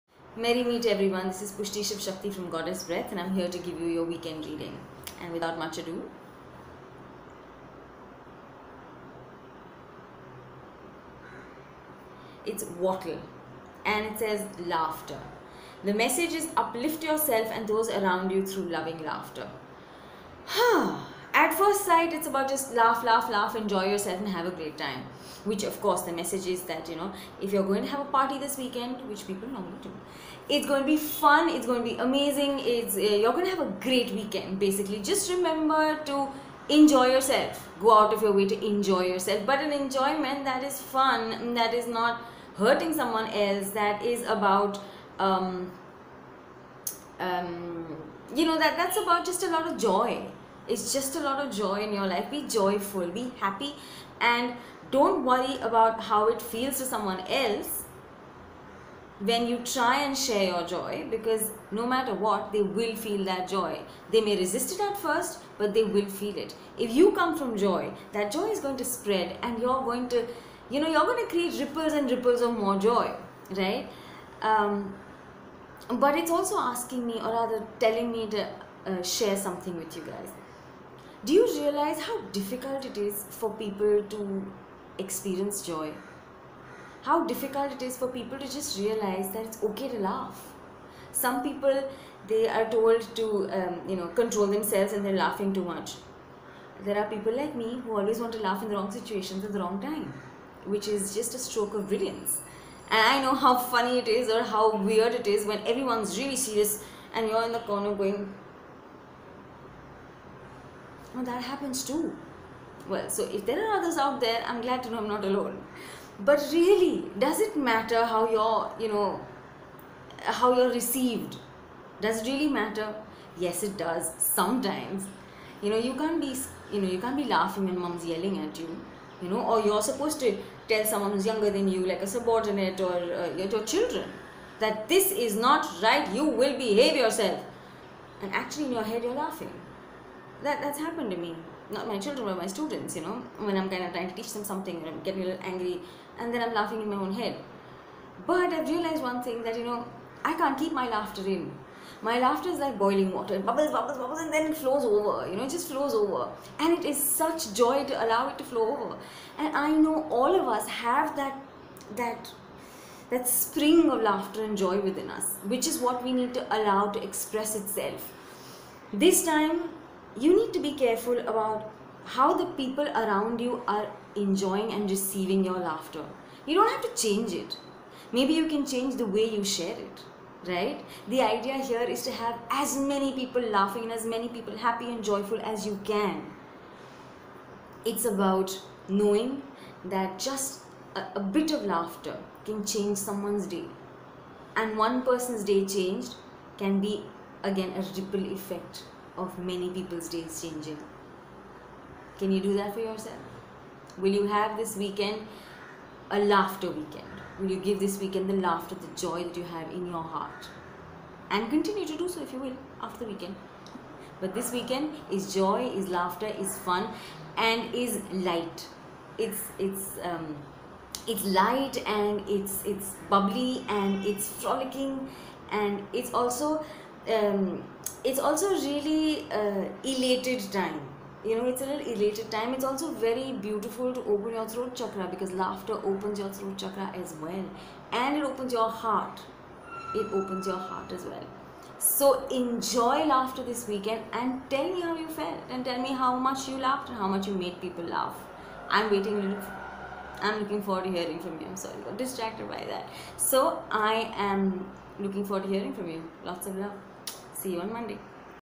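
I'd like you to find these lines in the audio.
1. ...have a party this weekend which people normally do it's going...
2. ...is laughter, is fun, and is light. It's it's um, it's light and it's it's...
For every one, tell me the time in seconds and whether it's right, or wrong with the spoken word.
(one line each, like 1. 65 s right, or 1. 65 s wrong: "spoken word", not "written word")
1. 27 s right
2. 215 s right.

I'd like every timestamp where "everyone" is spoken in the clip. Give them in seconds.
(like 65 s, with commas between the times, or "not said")
0 s, 105 s.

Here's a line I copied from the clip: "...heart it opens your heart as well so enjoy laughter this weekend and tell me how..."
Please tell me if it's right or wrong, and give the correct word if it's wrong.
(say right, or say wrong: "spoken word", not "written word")
right.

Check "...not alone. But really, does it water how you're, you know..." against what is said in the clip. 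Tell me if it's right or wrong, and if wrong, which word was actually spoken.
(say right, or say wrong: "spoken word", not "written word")
wrong: "matter", not "water".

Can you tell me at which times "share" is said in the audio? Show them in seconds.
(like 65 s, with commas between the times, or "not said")
60 s, 79 s, 179 s.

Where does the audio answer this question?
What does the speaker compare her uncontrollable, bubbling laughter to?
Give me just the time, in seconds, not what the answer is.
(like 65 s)
152 s.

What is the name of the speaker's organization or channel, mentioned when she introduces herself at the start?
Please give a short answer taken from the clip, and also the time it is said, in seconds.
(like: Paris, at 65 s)
Goddess Breath, at 2 s.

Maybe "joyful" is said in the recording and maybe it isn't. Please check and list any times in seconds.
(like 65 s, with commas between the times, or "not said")
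52 s, 185 s.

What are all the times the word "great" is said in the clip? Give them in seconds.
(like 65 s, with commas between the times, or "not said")
24 s, 33 s.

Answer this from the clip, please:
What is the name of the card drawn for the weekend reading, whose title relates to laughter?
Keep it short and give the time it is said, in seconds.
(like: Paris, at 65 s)
Wattle, at 12 s.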